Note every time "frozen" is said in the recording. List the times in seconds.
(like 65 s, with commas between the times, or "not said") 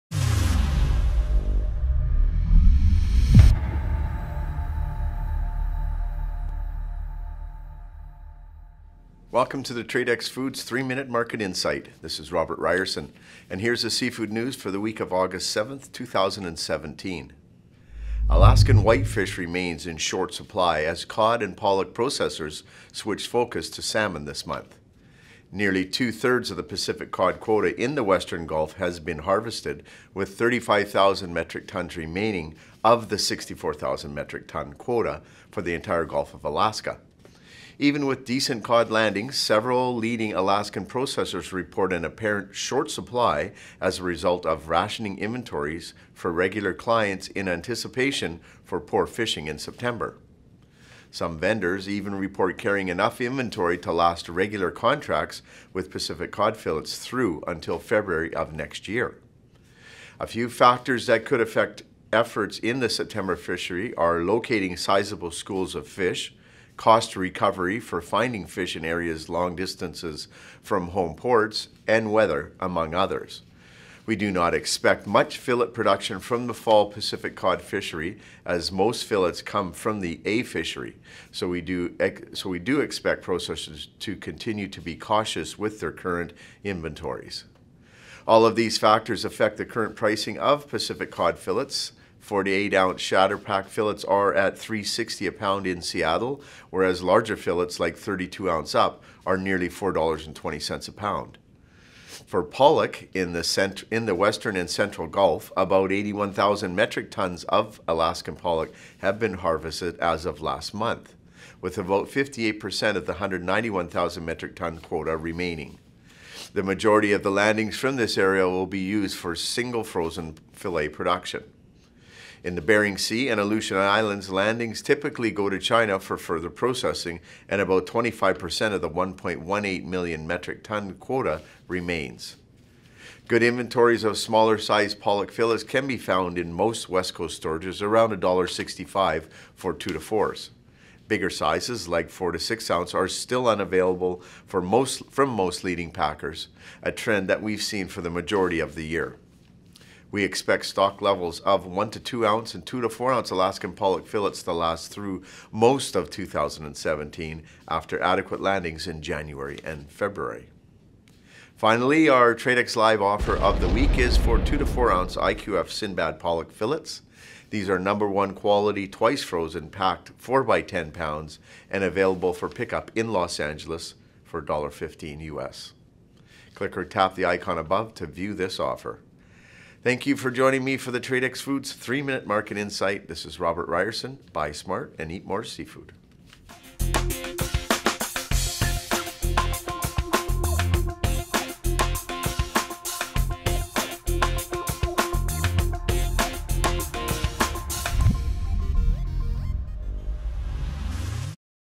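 119 s, 169 s.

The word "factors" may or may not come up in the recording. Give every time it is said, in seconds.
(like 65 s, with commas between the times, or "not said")
60 s, 88 s.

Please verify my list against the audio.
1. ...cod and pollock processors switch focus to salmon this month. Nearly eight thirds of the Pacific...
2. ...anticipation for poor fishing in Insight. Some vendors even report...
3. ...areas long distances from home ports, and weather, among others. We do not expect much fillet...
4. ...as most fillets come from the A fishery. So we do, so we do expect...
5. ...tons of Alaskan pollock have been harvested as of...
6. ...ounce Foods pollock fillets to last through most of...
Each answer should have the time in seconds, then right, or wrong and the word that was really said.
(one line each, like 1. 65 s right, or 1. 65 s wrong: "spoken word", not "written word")
1. 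21 s wrong: "two", not "eight"
2. 47 s wrong: "September", not "Insight"
3. 68 s right
4. 78 s right
5. 107 s right
6. 153 s wrong: "Alaskan", not "Foods".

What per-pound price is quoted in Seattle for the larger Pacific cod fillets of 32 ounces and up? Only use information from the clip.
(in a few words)
$4.20.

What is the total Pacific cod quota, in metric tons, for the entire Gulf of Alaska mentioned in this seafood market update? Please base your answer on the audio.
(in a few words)
64,000 metric tons.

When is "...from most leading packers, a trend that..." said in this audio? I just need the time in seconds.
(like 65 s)
145 s.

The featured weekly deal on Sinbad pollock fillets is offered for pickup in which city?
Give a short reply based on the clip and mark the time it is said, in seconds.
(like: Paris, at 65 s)
Los Angeles, at 173 s.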